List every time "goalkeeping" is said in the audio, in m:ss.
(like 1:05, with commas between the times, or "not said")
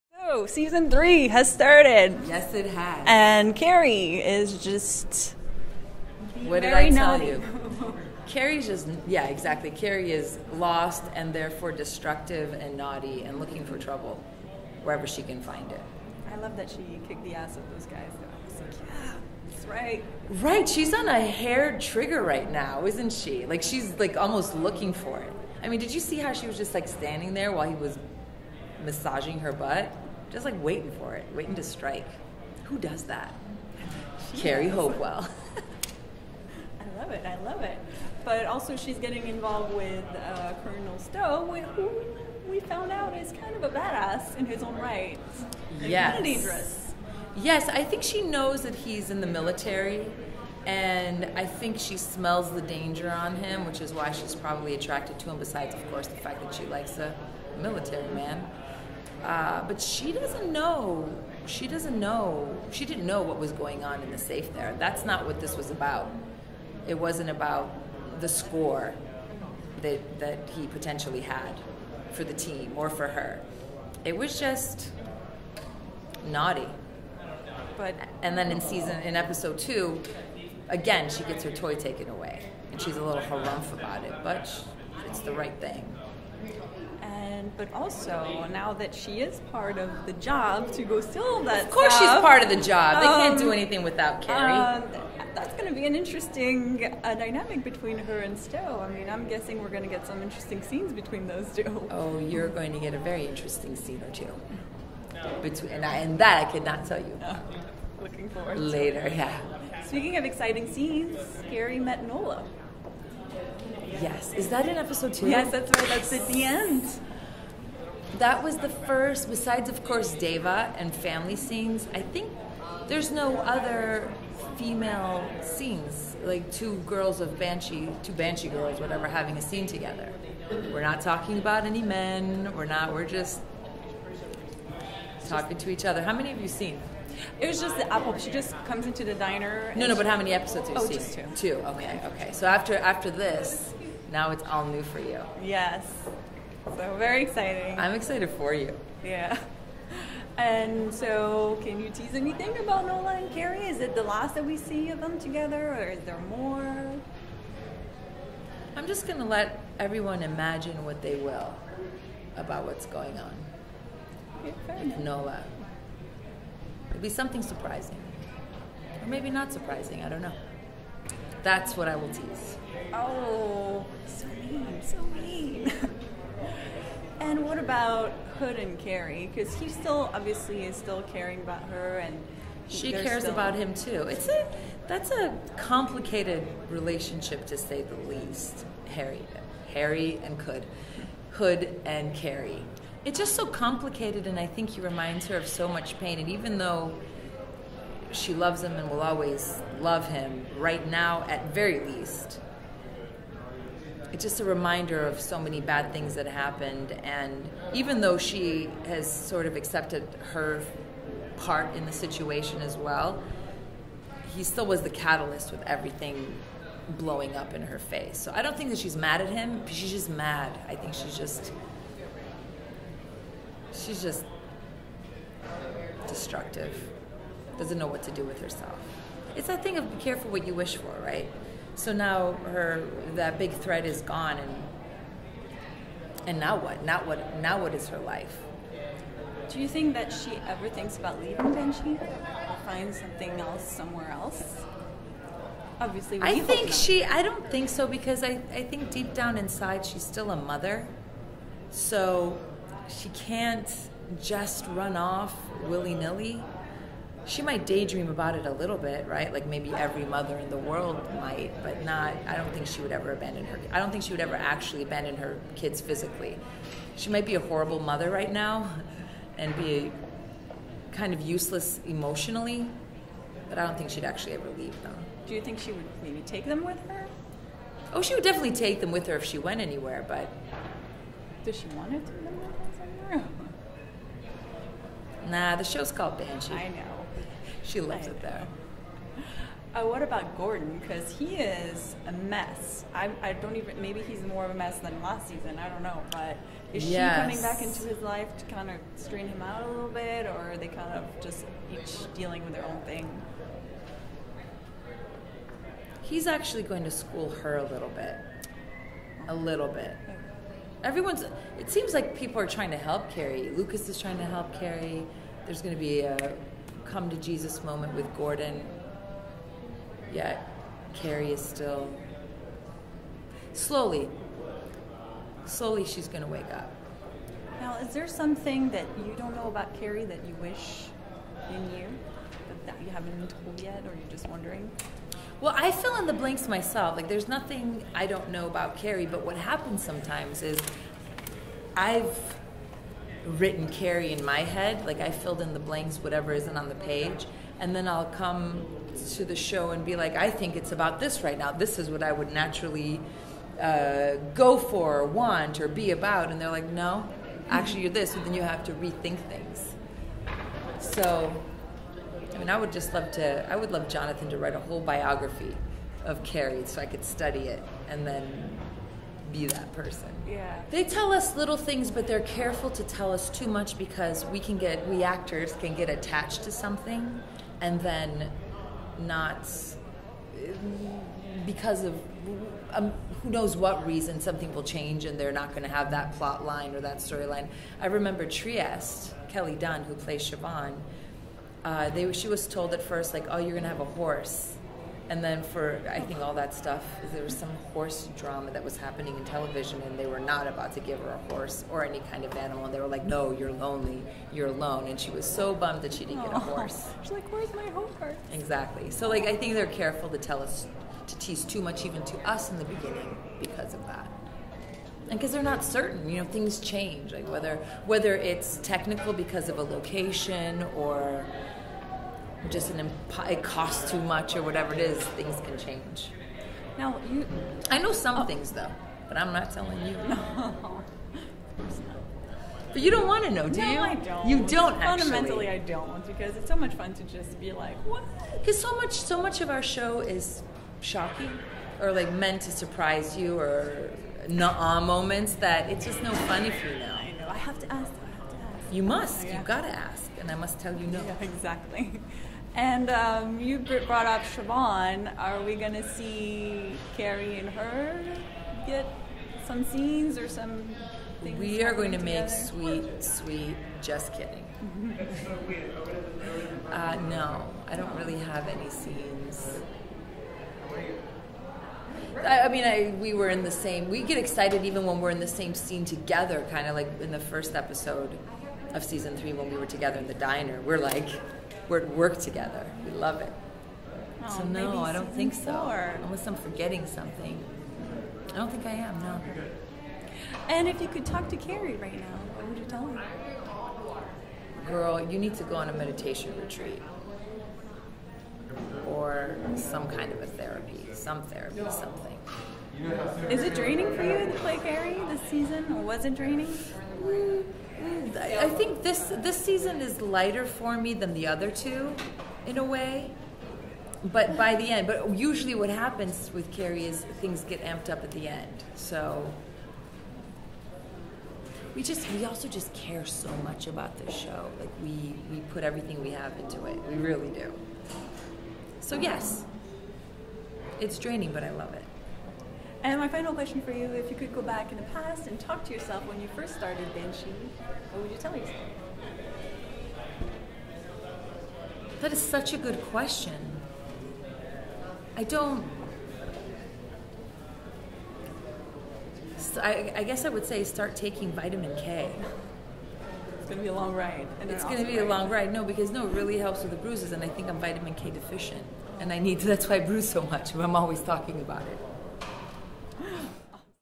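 not said.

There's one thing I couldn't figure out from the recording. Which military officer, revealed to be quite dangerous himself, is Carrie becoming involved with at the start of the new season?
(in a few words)
Colonel Stowe.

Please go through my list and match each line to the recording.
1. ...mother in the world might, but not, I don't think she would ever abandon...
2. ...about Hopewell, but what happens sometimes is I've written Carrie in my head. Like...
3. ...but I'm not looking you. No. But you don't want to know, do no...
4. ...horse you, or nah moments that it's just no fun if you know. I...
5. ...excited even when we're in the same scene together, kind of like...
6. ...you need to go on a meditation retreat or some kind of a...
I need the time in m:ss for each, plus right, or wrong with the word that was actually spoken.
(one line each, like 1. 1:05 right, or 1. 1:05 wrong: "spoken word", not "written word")
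1. 4:20 right
2. 5:38 wrong: "Carrie", not "Hopewell"
3. 7:09 wrong: "telling", not "looking"
4. 7:22 wrong: "surprise", not "horse"
5. 7:54 right
6. 8:15 right.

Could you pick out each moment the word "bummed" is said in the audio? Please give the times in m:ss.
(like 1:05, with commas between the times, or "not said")
6:45.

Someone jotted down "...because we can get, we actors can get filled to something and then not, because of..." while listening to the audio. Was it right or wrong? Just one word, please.
wrong.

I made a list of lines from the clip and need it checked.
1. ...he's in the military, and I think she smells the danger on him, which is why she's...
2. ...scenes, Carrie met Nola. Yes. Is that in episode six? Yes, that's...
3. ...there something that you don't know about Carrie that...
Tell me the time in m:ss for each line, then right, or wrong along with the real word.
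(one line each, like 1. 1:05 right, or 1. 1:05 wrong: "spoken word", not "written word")
1. 0:48 right
2. 1:50 wrong: "two", not "six"
3. 5:27 right.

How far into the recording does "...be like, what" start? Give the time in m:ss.
7:17.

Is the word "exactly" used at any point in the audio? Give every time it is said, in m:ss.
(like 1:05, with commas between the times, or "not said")
0:09, 6:48, 7:31.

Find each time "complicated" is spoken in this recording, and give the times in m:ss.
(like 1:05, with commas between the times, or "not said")
3:05, 3:13.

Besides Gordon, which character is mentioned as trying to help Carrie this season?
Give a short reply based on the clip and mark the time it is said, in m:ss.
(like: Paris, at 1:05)
Lucas, at 5:13.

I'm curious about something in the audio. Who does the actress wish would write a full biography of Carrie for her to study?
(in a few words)
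Jonathan.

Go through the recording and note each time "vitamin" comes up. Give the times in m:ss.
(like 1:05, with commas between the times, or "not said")
9:11, 9:17.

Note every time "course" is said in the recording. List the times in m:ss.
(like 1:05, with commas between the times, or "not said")
0:55, 1:31, 1:59.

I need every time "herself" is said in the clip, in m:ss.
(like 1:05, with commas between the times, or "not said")
3:48.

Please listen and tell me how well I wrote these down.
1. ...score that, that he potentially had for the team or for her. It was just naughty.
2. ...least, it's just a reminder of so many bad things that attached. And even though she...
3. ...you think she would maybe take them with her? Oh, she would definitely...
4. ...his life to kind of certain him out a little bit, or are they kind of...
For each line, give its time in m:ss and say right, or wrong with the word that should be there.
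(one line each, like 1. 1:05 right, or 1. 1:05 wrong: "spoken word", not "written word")
1. 1:08 right
2. 3:21 wrong: "happened", not "attached"
3. 4:35 right
4. 4:57 wrong: "strain", not "certain".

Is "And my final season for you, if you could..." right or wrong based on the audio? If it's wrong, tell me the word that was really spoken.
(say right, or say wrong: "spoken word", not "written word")
wrong: "question", not "season".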